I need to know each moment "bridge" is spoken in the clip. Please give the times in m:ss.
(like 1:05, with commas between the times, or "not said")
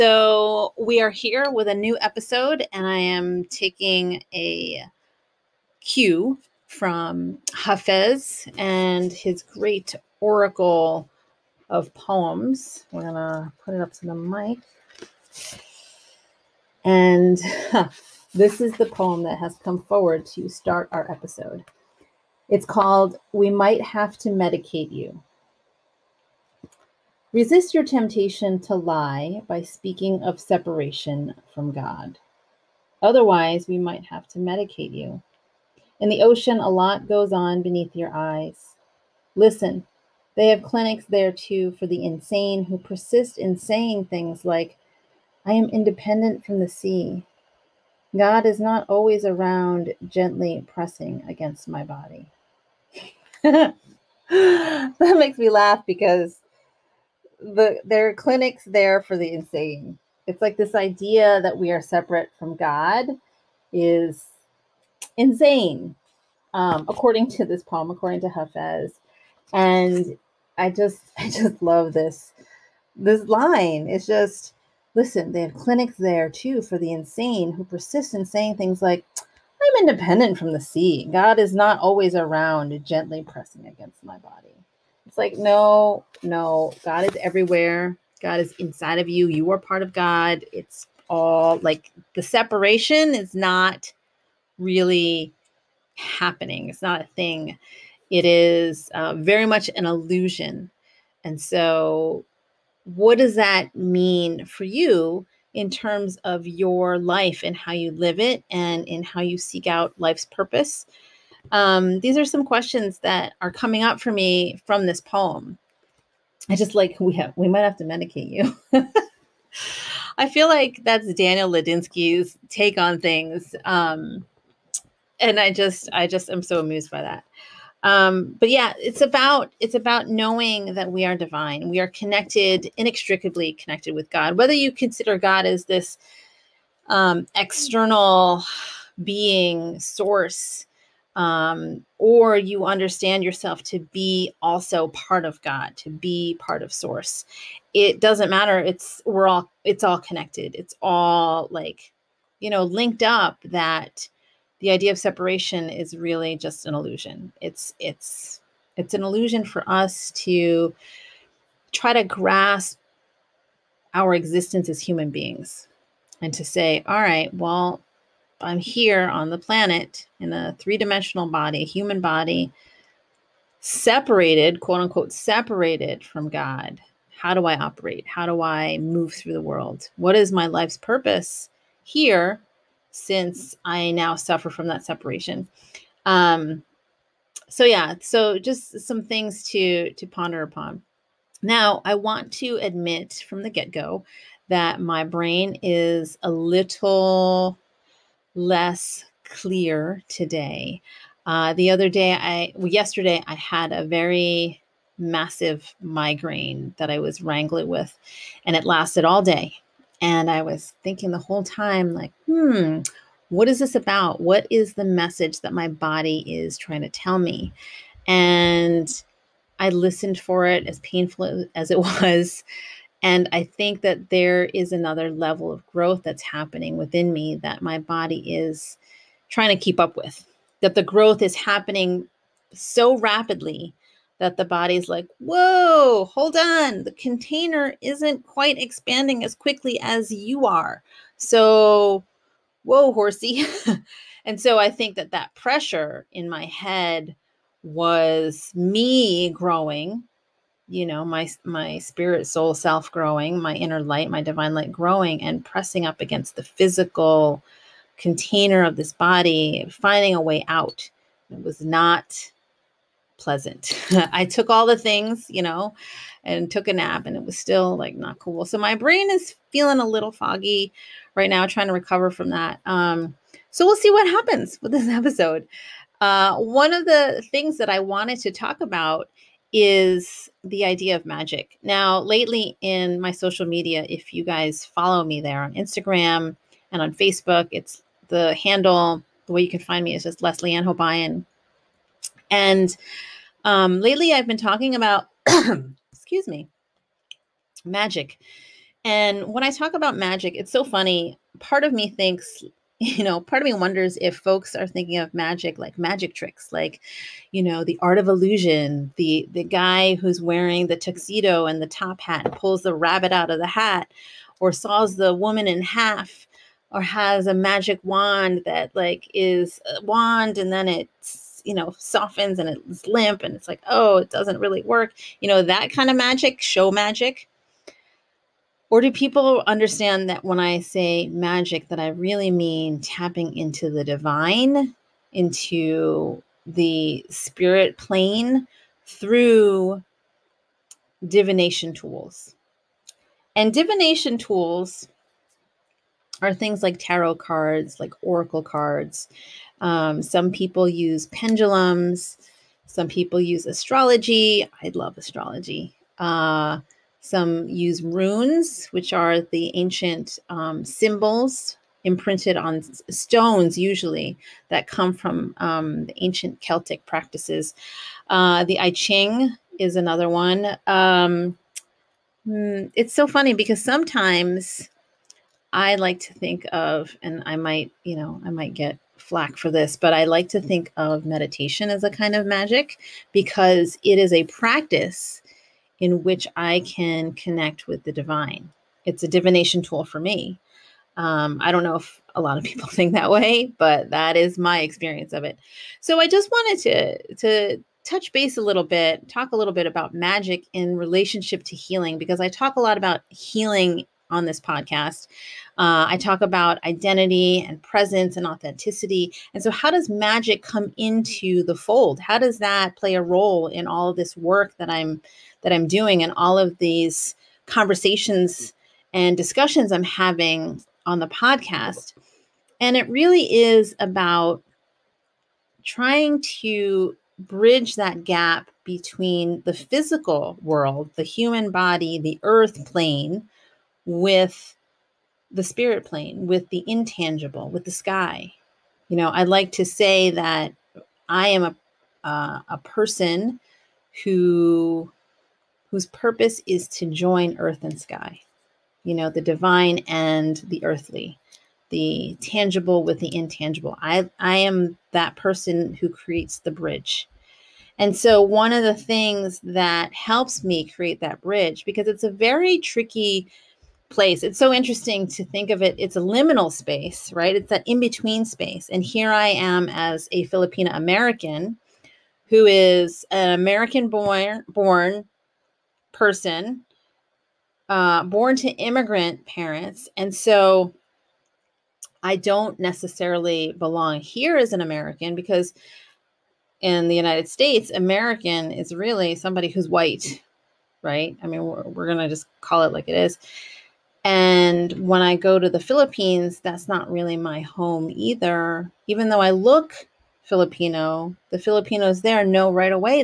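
7:07, 7:36, 7:41.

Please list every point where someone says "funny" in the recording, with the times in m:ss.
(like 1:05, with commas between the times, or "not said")
5:00, 6:13.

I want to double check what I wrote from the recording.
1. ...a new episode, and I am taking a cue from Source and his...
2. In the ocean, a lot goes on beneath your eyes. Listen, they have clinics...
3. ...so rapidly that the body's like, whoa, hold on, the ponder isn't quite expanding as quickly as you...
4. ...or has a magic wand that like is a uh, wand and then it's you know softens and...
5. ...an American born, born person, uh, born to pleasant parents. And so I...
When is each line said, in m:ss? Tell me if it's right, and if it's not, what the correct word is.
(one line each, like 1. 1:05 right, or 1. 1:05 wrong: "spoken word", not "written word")
1. 0:01 wrong: "Hafez", not "Source"
2. 0:35 right
3. 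3:52 wrong: "container", not "ponder"
4. 5:16 right
5. 7:53 wrong: "immigrant", not "pleasant".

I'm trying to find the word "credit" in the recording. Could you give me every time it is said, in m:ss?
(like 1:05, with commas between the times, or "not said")
not said.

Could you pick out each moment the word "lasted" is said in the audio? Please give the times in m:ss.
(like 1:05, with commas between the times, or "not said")
3:28.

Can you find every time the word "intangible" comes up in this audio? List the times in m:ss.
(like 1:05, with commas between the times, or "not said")
7:16, 7:33.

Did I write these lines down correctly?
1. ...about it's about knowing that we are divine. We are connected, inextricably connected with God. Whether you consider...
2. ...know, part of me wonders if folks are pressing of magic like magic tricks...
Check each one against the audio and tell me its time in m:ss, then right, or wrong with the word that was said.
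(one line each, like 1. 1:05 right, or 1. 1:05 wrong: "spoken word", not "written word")
1. 2:08 right
2. 5:03 wrong: "thinking", not "pressing".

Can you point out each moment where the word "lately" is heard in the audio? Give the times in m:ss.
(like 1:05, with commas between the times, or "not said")
4:41, 4:53.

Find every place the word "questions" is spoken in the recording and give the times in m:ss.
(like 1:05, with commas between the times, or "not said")
1:52.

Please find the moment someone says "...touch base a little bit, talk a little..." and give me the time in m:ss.
6:37.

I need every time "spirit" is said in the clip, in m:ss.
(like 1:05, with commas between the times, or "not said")
4:11, 5:37, 7:15.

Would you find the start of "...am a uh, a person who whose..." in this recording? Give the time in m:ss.
7:21.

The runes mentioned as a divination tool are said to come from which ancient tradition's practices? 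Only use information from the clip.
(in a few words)
Celtic.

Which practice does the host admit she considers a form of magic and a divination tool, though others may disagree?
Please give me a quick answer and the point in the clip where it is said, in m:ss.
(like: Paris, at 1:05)
meditation, at 6:21.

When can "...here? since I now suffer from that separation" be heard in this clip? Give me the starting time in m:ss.
3:01.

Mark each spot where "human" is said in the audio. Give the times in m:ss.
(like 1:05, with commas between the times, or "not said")
2:44, 2:51, 7:11.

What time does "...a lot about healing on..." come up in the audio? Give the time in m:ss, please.
6:42.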